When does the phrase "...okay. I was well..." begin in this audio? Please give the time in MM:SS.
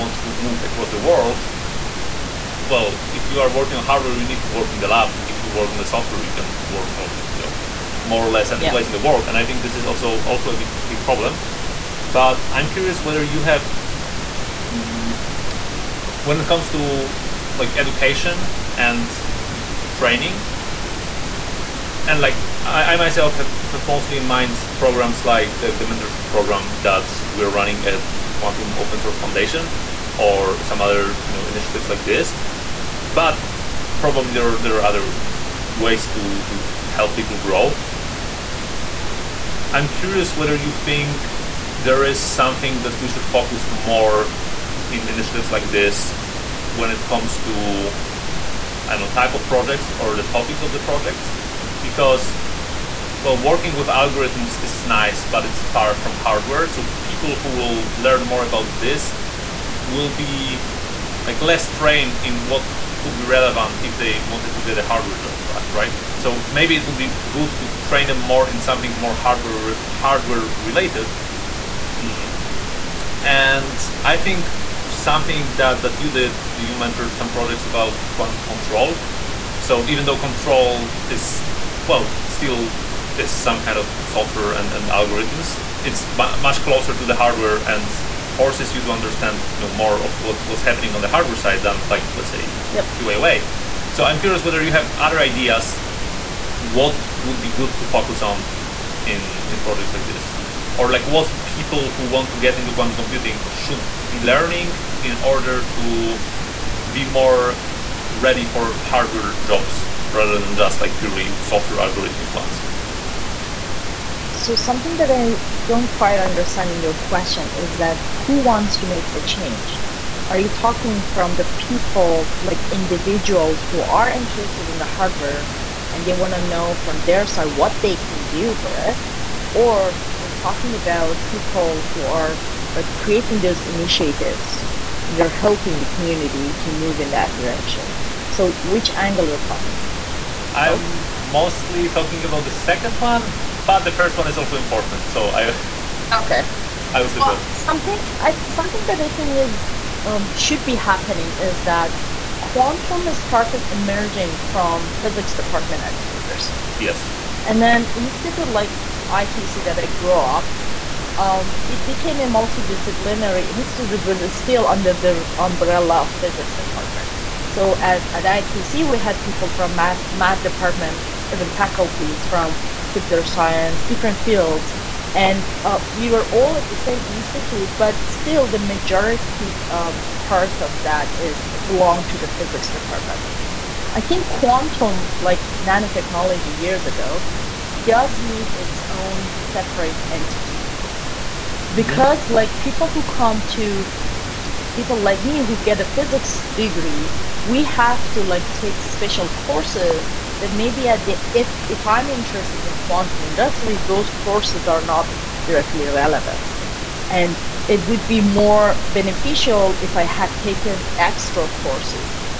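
02:26.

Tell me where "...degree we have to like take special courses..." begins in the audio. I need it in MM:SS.
03:16.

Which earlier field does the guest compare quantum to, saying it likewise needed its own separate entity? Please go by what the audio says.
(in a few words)
nanotechnology.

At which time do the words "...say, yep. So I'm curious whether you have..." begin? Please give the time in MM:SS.
01:32.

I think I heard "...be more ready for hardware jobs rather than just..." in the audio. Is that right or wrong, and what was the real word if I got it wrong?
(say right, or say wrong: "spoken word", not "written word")
right.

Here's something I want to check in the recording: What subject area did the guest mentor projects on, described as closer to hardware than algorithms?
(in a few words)
quantum control.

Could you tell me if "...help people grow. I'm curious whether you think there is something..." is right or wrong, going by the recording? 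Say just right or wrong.
right.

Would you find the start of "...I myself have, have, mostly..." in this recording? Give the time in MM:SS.
00:22.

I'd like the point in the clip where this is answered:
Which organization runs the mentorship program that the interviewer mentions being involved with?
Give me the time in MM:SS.
00:28.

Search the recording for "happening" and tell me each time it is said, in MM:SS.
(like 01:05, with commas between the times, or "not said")
01:30, 02:30.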